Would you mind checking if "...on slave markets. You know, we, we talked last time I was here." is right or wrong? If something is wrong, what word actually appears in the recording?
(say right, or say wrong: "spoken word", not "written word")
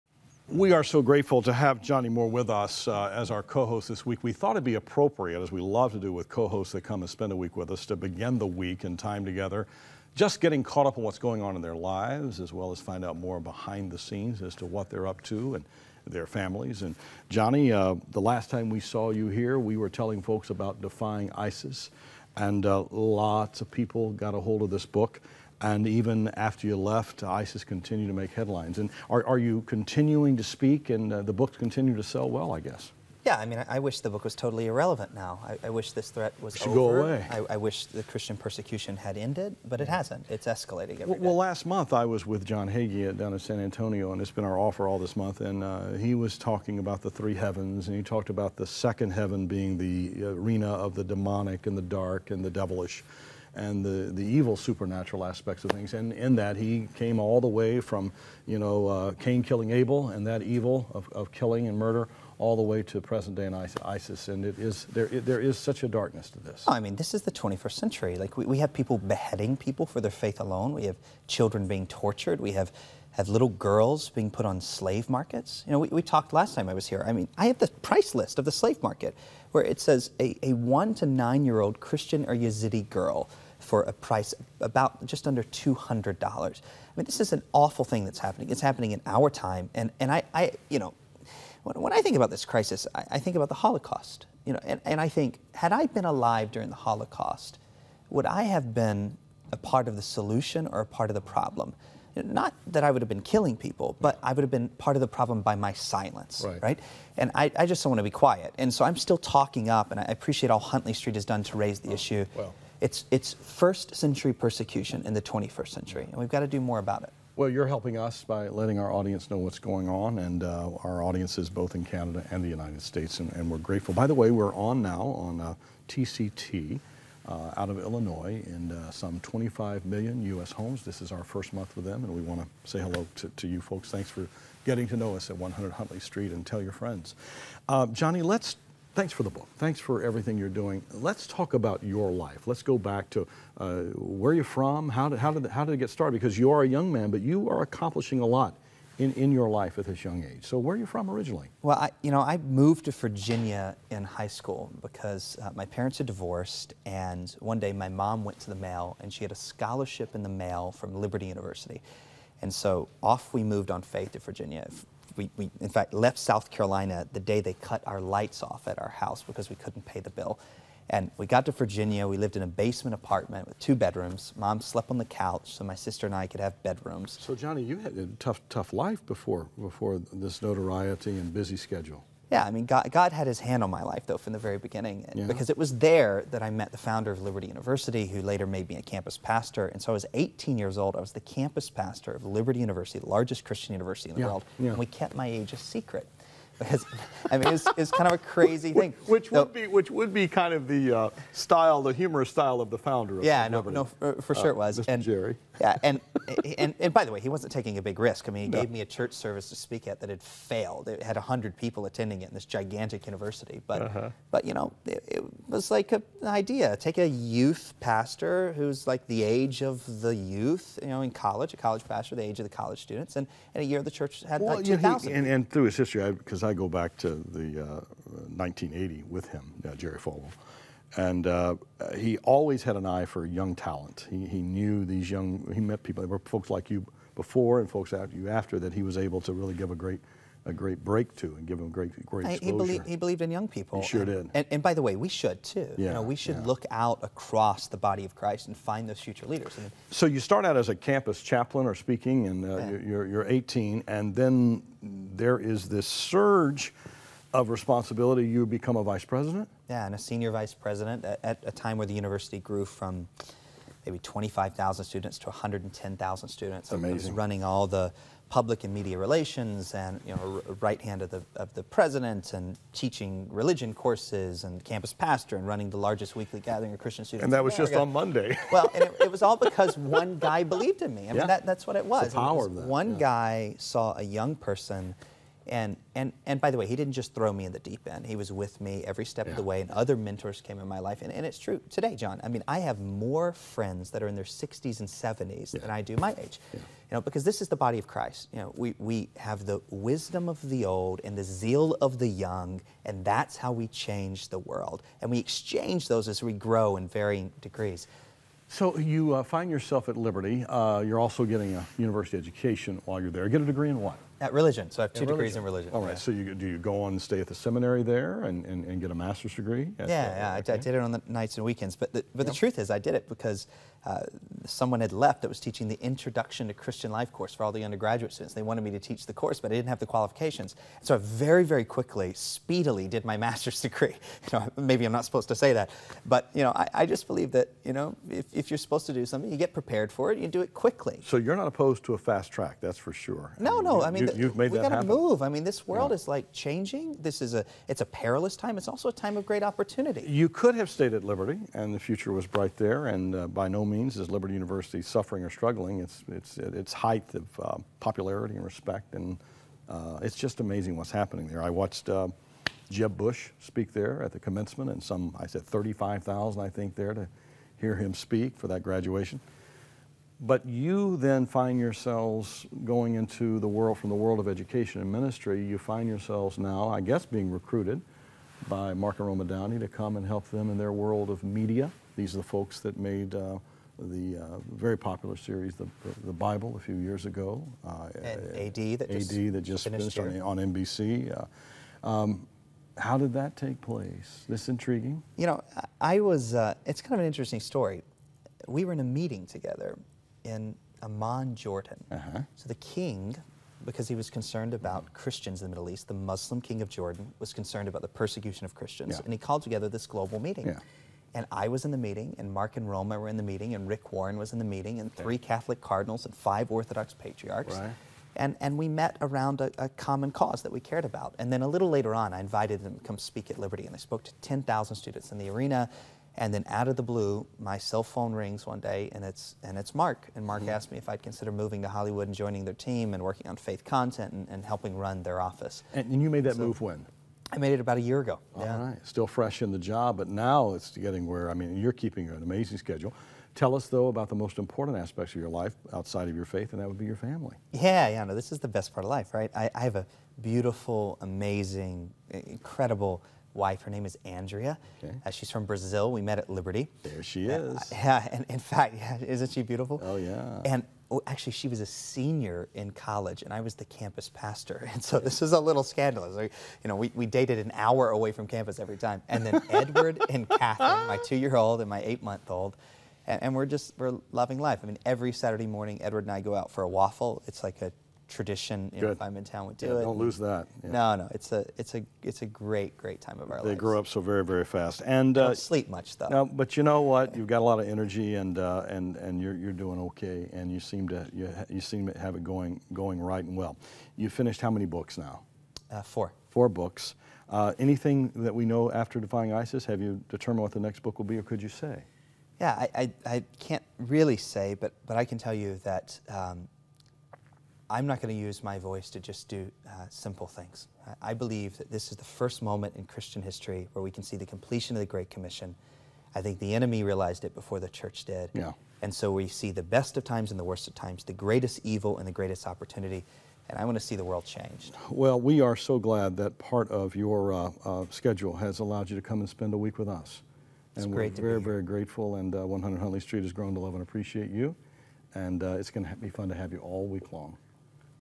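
right.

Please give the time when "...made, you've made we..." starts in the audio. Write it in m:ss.
5:44.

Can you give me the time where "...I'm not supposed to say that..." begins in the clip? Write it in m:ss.
5:34.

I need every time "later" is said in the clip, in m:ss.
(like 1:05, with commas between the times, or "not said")
3:08, 7:01.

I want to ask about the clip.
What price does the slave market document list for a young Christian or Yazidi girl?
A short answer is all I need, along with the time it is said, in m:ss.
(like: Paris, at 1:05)
just under $200, at 1:25.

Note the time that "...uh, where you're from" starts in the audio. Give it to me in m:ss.
2:23.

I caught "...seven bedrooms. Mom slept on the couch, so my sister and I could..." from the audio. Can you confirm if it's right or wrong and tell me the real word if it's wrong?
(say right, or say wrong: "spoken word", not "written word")
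wrong: "two", not "seven".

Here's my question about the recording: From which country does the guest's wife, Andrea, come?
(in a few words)
Brazil.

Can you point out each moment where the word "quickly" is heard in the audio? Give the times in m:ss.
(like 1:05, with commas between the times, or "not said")
5:31, 5:40.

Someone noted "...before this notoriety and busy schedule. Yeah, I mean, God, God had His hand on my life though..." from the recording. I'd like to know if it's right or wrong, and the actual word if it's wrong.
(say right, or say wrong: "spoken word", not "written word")
right.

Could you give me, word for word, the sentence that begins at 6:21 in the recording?
These are the folks that made uh, the uh, very popular series, the, the Bible, a few years ago.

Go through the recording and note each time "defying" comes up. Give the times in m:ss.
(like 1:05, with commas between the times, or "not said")
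0:20, 8:18.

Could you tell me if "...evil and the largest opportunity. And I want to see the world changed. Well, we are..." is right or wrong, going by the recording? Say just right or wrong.
wrong.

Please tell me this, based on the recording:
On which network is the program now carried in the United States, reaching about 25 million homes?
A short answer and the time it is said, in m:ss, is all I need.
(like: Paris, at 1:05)
TCT, at 2:05.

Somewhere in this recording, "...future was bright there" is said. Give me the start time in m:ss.
5:51.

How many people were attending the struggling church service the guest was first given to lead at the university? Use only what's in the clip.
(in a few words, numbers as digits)
100.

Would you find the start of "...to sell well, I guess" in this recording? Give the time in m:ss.
0:31.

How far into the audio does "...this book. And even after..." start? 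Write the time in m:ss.
0:24.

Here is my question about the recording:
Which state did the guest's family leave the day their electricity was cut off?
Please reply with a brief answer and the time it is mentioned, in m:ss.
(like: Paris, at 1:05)
South Carolina, at 2:46.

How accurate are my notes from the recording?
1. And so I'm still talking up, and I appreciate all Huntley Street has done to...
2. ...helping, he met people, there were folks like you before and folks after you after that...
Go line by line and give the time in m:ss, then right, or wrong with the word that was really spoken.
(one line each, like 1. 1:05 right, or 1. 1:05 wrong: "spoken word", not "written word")
1. 1:48 right
2. 3:55 wrong: "young", not "helping".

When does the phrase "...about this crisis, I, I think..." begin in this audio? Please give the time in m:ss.
1:32.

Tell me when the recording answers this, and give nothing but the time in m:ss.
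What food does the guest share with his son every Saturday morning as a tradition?
7:56.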